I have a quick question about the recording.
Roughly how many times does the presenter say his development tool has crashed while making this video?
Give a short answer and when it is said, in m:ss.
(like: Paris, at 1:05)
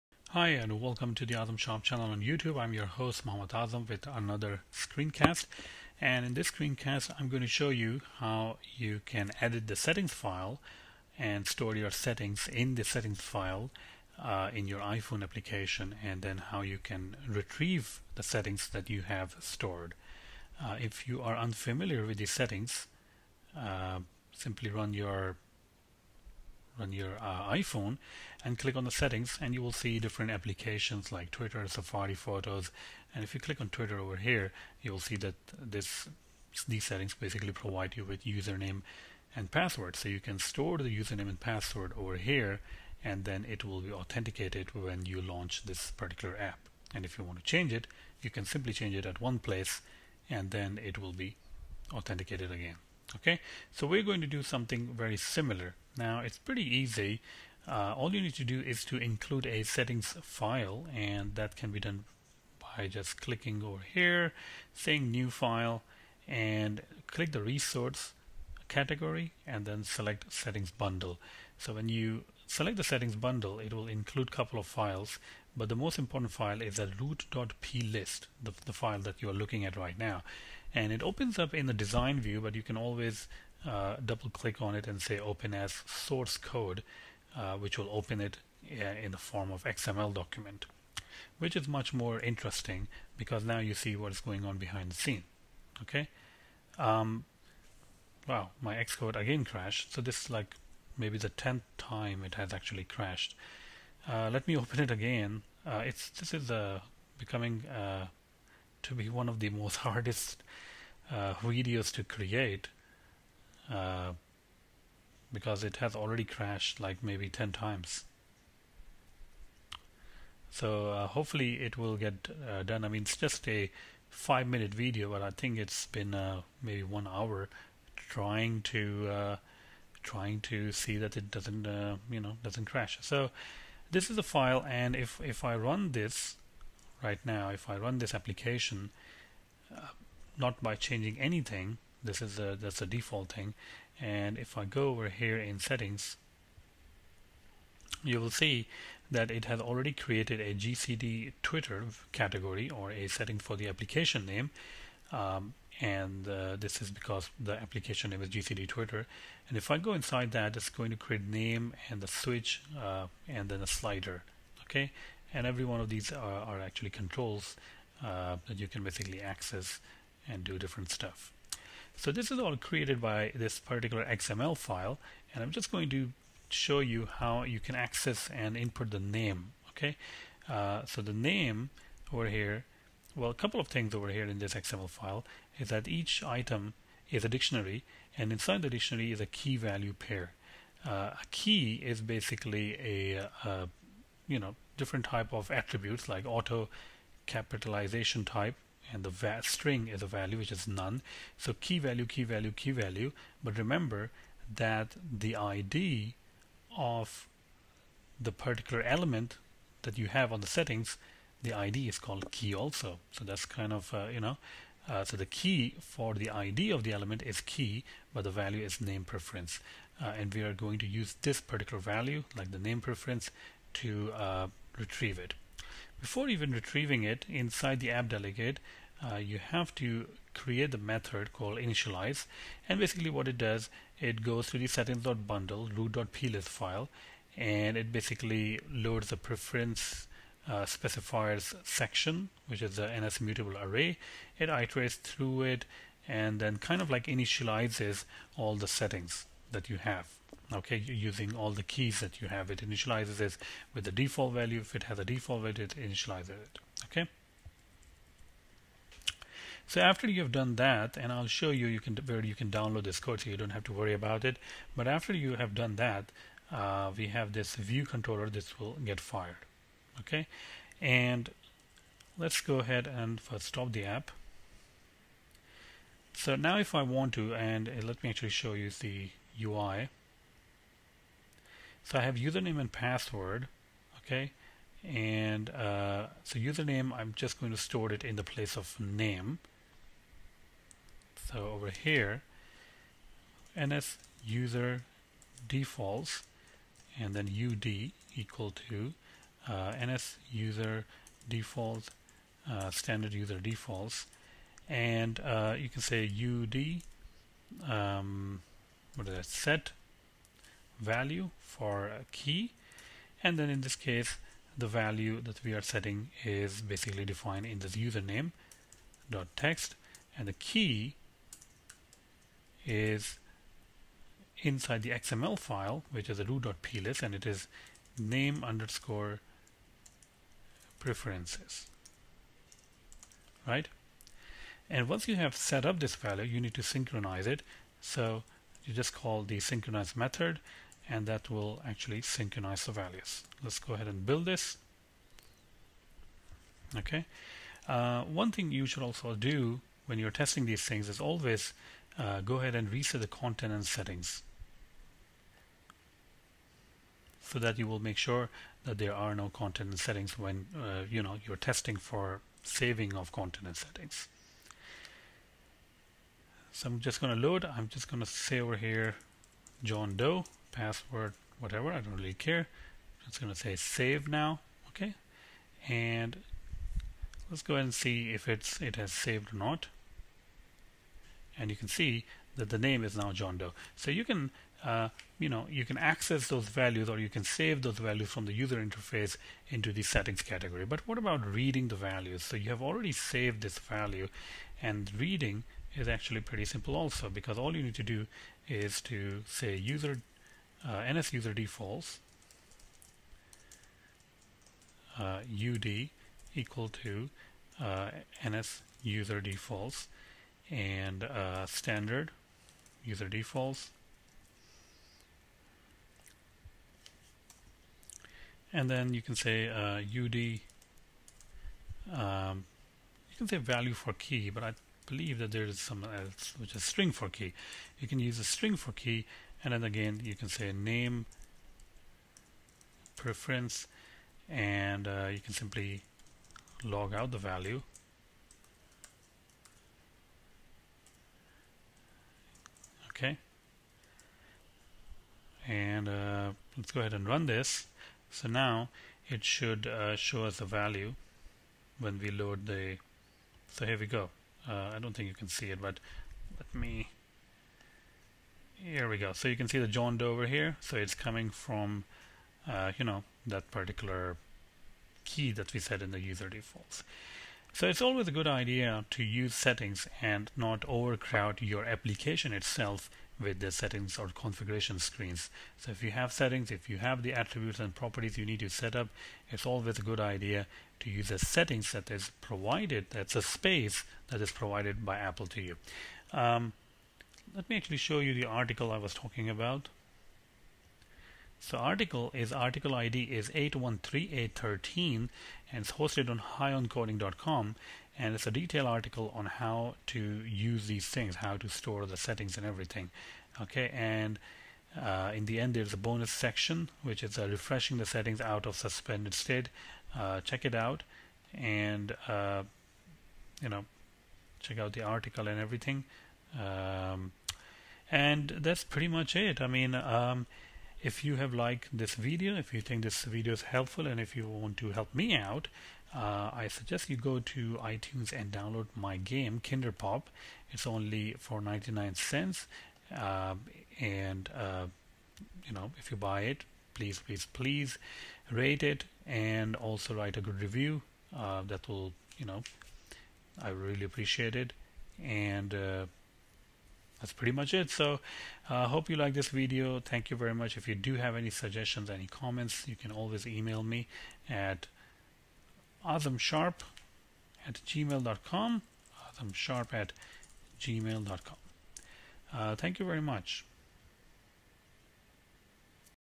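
10, at 1:41.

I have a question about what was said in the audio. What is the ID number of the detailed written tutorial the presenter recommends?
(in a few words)
813813.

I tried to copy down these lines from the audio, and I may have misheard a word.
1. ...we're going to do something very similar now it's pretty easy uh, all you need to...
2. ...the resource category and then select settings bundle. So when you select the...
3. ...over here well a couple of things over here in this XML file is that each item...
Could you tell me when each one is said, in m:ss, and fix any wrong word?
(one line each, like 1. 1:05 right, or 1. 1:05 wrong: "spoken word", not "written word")
1. 0:53 right
2. 1:07 right
3. 3:02 right.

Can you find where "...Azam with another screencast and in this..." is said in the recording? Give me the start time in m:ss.
0:03.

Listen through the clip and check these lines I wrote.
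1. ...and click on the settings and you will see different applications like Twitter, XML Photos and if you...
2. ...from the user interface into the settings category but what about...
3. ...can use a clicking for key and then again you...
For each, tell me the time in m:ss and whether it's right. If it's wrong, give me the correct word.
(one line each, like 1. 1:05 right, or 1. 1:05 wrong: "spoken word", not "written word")
1. 0:28 wrong: "Safari", not "XML"
2. 6:28 right
3. 7:07 wrong: "string", not "clicking".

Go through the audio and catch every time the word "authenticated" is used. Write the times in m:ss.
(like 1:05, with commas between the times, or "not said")
0:43, 0:51.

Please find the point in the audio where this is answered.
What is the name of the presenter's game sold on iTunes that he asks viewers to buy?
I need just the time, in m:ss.
8:49.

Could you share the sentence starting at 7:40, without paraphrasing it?
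So it's coming from, uh, you know, that particular key that we set in the user defaults.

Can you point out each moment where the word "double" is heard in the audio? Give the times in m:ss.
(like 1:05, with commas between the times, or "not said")
1:24.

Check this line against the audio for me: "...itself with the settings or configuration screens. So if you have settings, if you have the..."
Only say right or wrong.
right.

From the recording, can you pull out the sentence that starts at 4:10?
Okay, using all the keys that you have, it initializes it with the default value.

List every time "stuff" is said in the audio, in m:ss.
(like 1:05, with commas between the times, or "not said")
2:50.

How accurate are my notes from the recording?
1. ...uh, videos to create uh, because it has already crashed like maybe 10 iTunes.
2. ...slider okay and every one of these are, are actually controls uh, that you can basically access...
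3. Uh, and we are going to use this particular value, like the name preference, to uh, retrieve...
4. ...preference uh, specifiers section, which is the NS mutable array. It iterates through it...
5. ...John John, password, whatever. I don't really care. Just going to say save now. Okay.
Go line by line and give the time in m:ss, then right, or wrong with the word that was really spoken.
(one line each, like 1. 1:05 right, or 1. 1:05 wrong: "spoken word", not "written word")
1. 1:51 wrong: "times", not "iTunes"
2. 2:43 right
3. 3:40 right
4. 3:59 right
5. 6:09 wrong: "Doe", not "John".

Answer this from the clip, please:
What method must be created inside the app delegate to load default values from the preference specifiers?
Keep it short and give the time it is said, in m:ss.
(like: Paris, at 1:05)
initialize, at 3:51.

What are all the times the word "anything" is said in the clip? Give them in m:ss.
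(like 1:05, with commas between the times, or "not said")
2:21.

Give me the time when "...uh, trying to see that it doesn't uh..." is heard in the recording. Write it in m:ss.
2:09.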